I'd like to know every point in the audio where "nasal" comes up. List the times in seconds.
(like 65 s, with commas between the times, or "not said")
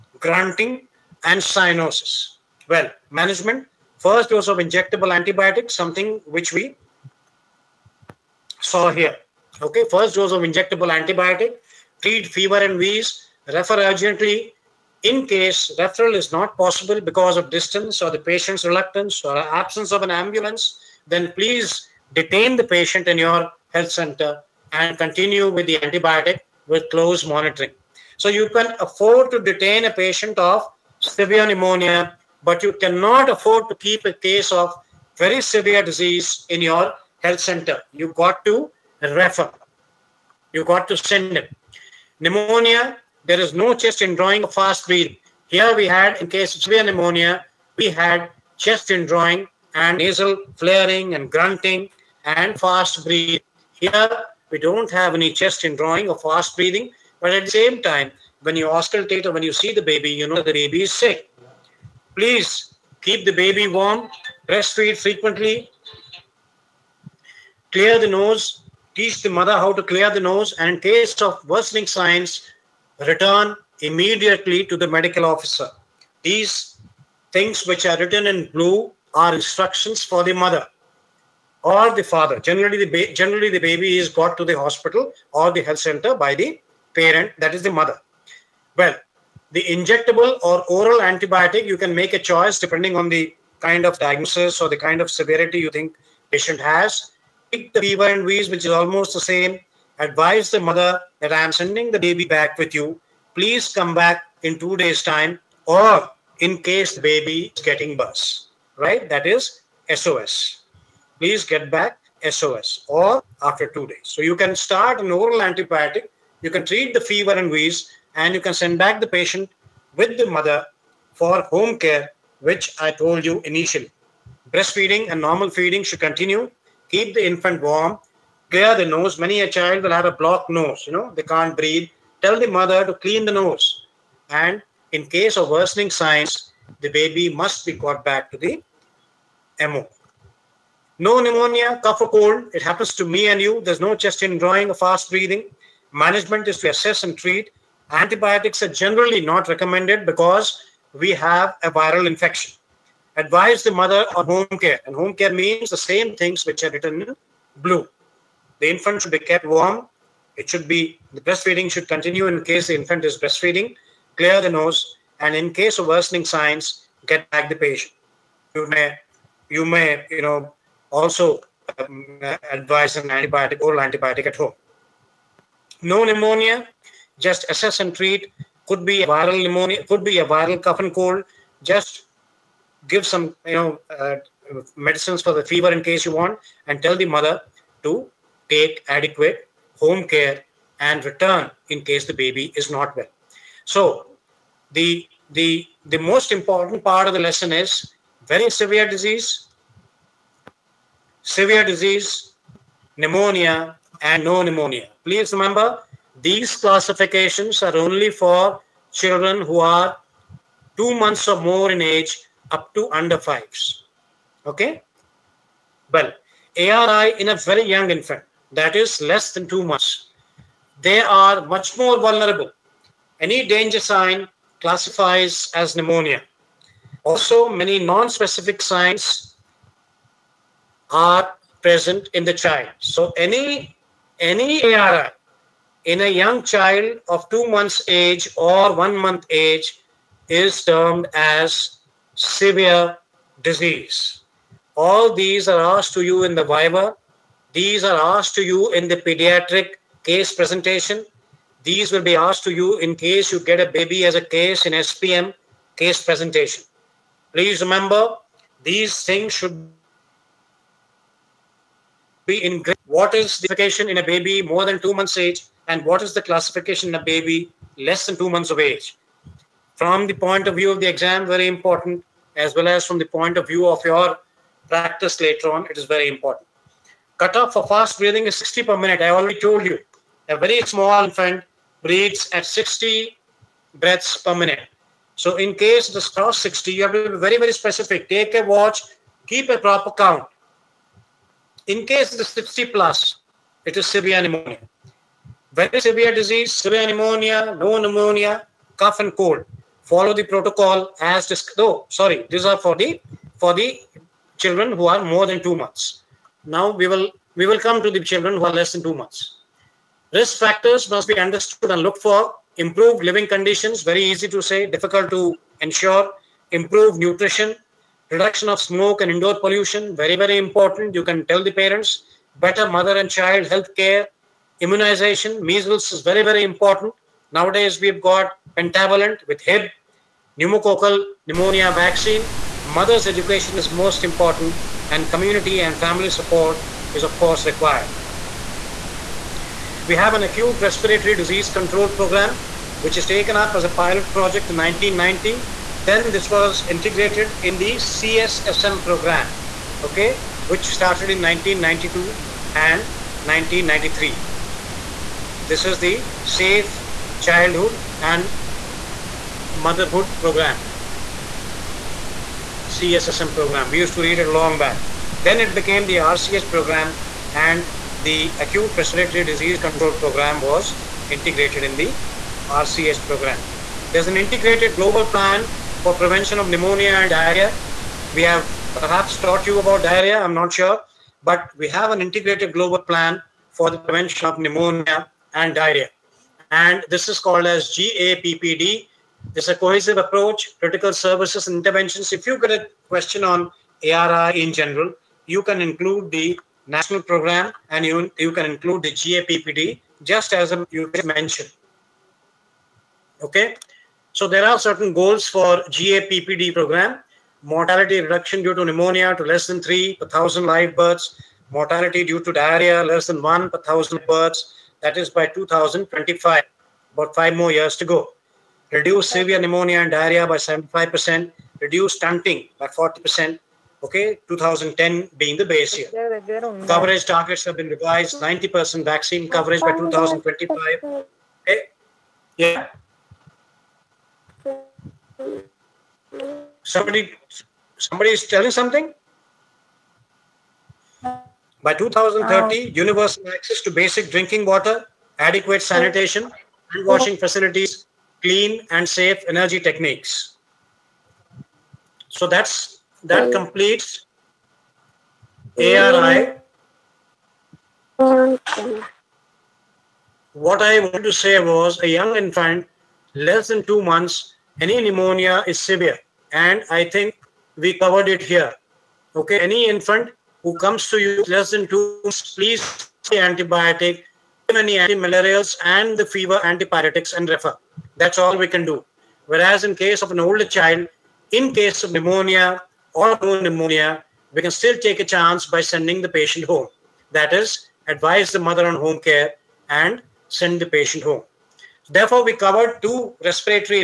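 49 s.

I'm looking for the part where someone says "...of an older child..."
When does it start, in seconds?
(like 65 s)
480 s.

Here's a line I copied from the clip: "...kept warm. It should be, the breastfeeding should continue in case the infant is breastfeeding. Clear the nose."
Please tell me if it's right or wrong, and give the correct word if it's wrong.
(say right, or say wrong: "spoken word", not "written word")
right.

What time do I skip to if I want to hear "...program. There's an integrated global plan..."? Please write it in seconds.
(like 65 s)
373 s.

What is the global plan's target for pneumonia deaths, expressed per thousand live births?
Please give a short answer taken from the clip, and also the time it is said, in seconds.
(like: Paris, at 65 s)
Less than 3, at 409 s.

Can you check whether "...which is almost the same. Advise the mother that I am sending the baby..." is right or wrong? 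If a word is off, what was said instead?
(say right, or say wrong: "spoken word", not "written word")
right.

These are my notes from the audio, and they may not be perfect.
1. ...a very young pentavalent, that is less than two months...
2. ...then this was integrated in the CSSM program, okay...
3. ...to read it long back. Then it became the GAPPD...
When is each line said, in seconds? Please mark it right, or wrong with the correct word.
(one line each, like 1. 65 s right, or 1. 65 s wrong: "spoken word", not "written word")
1. 217 s wrong: "infant", not "pentavalent"
2. 345 s right
3. 363 s wrong: "RCS", not "GAPPD".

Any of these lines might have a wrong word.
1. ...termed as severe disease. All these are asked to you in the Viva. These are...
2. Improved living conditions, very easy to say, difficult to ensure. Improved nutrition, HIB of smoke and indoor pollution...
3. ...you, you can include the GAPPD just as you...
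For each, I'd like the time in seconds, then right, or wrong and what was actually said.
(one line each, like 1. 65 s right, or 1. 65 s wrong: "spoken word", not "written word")
1. 240 s right
2. 312 s wrong: "Reduction", not "HIB"
3. 397 s right.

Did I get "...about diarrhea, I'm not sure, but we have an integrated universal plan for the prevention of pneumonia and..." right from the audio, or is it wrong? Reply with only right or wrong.
wrong.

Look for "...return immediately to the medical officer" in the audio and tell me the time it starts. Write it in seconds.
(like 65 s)
73 s.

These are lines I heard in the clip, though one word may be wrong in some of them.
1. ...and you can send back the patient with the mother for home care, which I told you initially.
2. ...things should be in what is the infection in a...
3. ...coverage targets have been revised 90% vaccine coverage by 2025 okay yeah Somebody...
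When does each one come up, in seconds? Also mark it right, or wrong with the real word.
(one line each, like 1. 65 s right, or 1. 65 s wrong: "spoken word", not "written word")
1. 118 s right
2. 259 s wrong: "classification", not "infection"
3. 426 s right.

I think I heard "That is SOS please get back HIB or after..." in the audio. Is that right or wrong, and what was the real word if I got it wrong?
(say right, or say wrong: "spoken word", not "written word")
wrong: "SOS", not "HIB".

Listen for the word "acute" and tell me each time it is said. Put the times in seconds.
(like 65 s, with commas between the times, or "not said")
340 s, 368 s.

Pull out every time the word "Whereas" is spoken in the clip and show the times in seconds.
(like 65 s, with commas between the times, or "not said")
479 s.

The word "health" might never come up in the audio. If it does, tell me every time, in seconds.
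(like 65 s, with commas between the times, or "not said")
23 s, 37 s, 85 s, 323 s.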